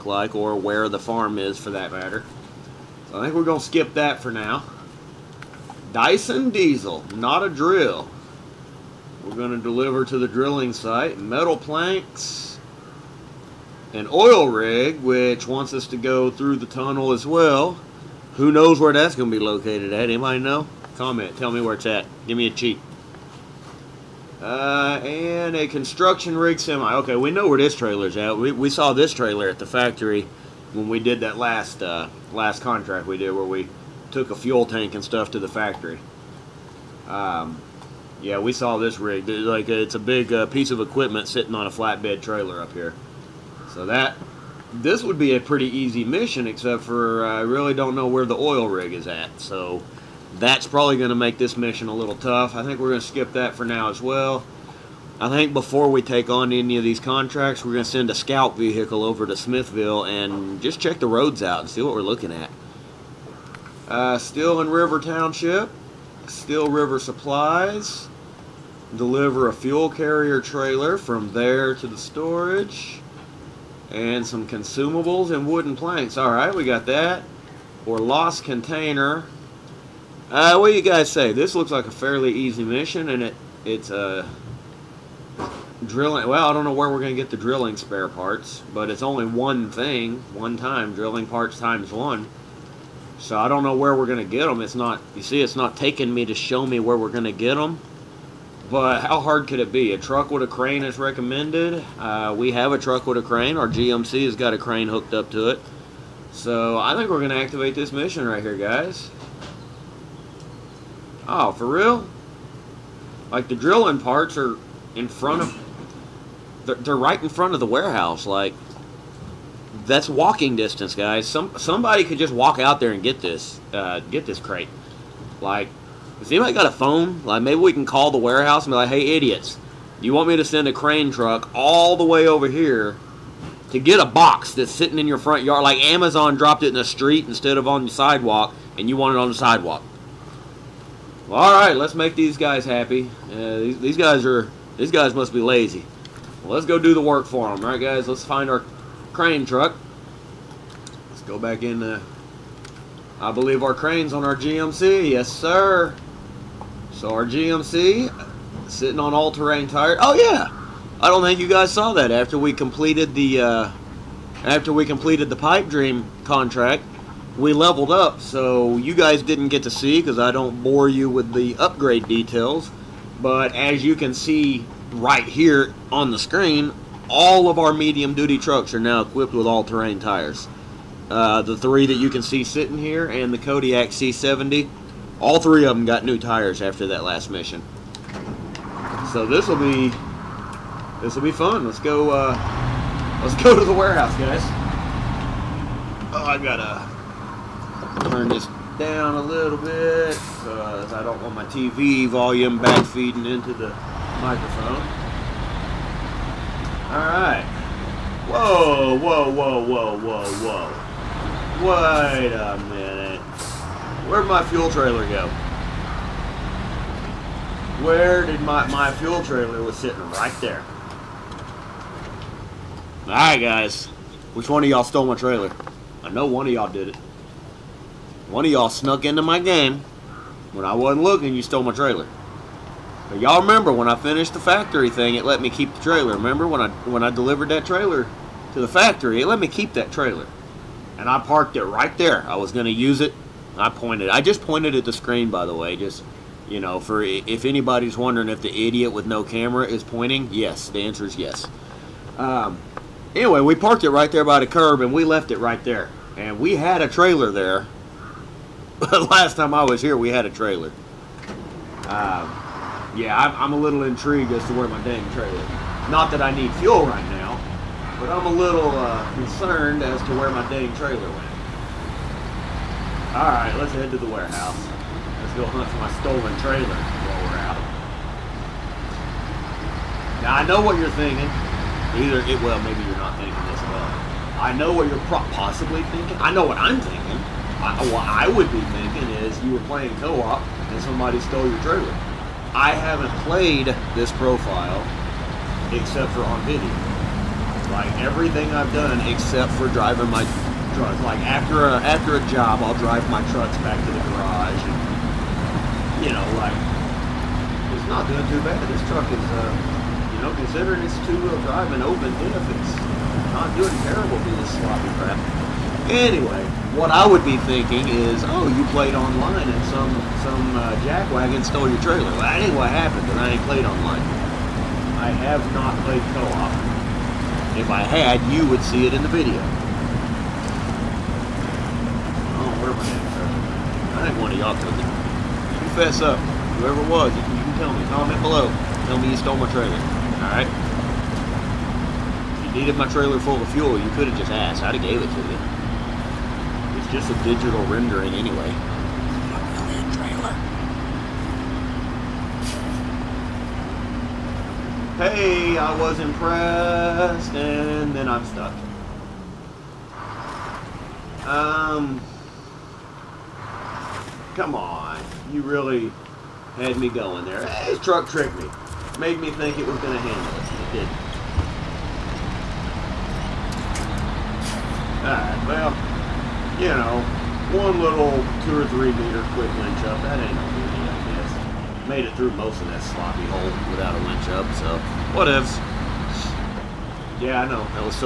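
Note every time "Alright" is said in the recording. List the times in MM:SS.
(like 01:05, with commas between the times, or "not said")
01:16, 03:26, 03:43, 05:40.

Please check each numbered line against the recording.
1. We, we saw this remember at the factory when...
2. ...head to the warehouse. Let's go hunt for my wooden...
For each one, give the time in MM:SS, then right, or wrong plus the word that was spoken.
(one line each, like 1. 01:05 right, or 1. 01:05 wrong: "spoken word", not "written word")
1. 00:28 wrong: "trailer", not "remember"
2. 04:33 wrong: "stolen", not "wooden".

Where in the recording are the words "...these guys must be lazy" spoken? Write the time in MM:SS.
02:24.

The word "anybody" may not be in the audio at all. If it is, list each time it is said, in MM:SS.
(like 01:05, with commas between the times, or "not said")
00:20, 02:06, 04:07.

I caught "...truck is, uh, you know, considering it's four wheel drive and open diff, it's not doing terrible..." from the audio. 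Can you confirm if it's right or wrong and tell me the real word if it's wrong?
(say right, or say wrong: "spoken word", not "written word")
wrong: "two", not "four".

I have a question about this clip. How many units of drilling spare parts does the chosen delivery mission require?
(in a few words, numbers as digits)
1.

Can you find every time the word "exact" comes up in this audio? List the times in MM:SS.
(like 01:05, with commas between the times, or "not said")
not said.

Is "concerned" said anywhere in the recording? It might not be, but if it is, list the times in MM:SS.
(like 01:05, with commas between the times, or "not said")
04:29.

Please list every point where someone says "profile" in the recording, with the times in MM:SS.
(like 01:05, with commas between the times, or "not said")
04:54.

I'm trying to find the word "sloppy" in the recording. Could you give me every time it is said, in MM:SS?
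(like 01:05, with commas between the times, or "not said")
05:14, 06:22.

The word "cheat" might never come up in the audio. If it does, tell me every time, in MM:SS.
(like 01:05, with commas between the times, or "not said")
00:22.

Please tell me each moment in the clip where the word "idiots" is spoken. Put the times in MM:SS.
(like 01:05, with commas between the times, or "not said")
02:09, 04:08.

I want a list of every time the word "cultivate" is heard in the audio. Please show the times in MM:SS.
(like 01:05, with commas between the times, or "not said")
not said.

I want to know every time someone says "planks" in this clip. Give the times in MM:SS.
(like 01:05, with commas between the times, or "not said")
00:11, 01:15.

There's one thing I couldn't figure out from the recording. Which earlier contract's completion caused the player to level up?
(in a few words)
Pipe dream.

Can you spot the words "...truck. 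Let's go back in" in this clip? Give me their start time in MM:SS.
02:29.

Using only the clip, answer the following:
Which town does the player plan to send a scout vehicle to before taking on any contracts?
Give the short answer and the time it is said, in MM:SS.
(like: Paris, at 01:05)
Smithville, at 00:59.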